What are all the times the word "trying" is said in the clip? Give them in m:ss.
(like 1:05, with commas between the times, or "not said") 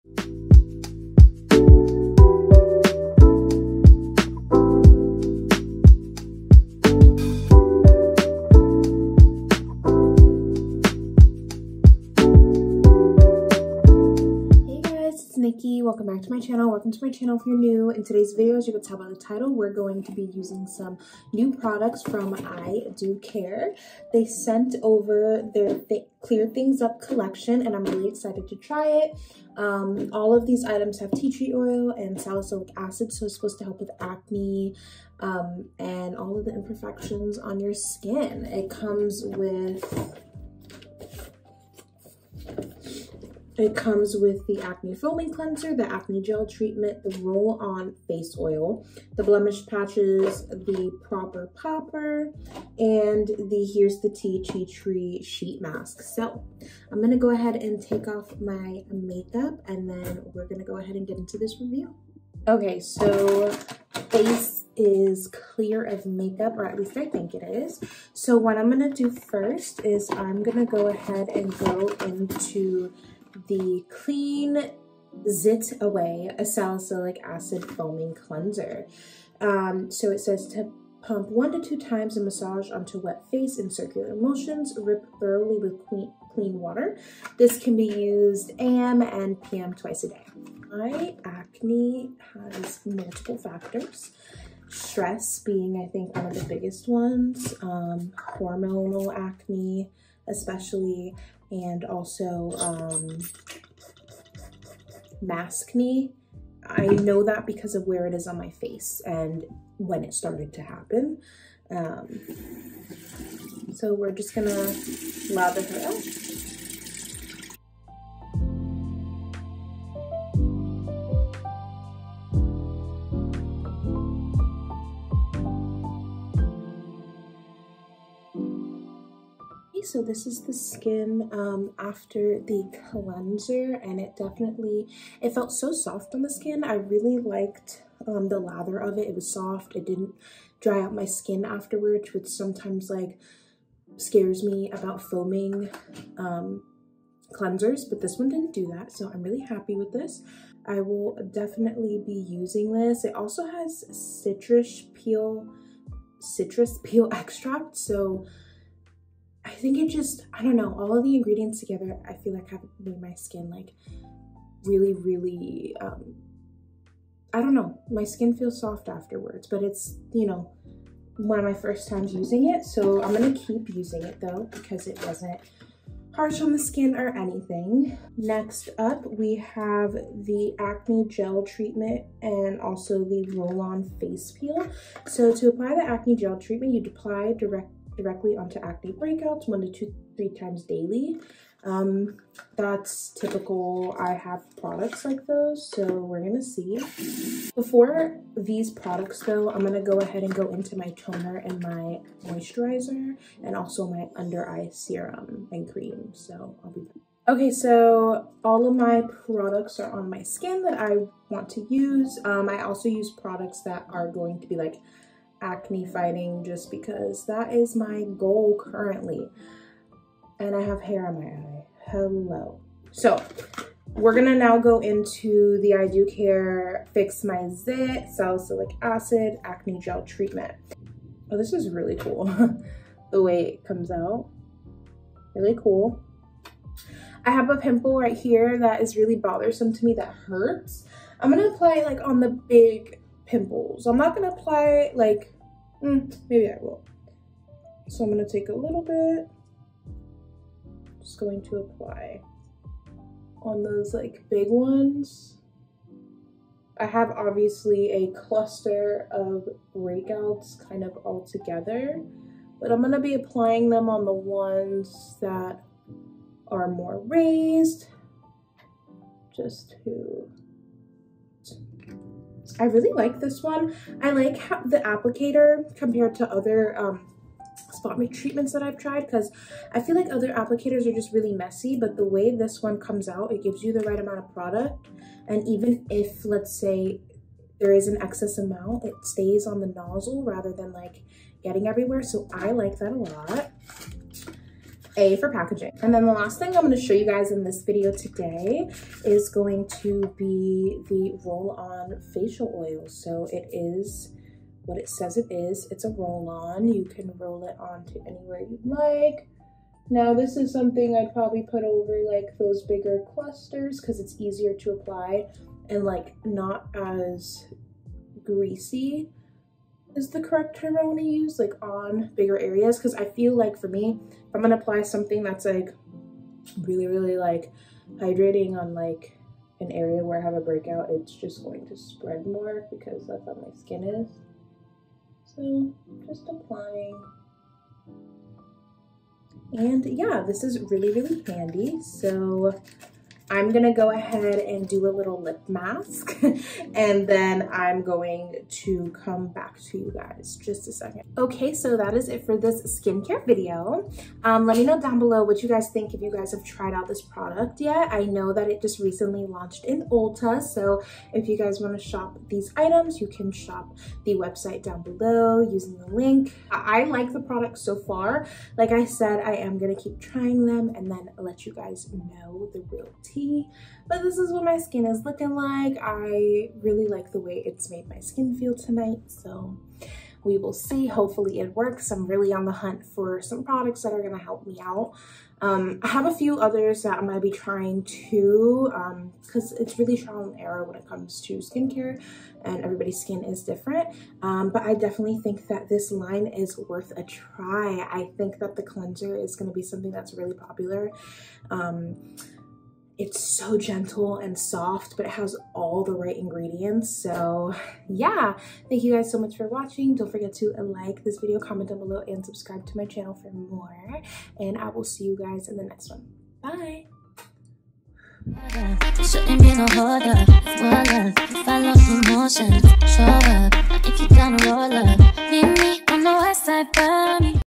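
6:10, 6:27.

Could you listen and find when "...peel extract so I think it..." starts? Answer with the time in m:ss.
2:36.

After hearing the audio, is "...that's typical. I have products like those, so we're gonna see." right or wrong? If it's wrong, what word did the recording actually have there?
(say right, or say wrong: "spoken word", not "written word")
right.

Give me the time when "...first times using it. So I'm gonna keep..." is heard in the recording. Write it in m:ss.
2:51.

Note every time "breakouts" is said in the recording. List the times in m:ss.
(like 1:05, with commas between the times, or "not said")
3:08, 4:19, 5:30.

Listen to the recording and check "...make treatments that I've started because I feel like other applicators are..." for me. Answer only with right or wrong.
wrong.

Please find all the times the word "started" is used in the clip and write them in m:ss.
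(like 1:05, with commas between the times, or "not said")
1:50.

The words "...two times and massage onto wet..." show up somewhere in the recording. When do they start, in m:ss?
1:21.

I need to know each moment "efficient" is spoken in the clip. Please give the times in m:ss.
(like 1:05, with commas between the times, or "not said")
not said.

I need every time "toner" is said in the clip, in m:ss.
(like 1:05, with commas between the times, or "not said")
3:20.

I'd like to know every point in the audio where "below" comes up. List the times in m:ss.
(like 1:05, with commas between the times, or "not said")
5:54, 6:04, 6:51.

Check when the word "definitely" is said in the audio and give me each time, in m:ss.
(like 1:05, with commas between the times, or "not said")
2:14, 2:31, 6:34.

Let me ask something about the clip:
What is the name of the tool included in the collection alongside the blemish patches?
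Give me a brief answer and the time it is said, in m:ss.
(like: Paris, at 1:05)
proper popper, at 0:51.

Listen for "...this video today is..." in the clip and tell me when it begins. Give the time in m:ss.
4:57.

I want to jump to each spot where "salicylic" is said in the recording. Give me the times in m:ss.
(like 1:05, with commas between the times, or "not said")
0:32, 1:16, 3:48.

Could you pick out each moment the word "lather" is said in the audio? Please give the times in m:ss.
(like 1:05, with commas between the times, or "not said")
1:55, 2:18.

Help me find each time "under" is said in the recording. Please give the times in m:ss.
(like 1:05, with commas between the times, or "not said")
3:24.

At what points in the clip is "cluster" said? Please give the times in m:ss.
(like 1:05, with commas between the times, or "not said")
4:18, 5:13.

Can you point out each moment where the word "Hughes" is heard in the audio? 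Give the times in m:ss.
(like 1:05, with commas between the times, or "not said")
not said.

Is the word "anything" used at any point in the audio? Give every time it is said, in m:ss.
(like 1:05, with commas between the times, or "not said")
2:57.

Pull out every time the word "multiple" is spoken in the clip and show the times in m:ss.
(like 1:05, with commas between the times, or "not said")
1:32.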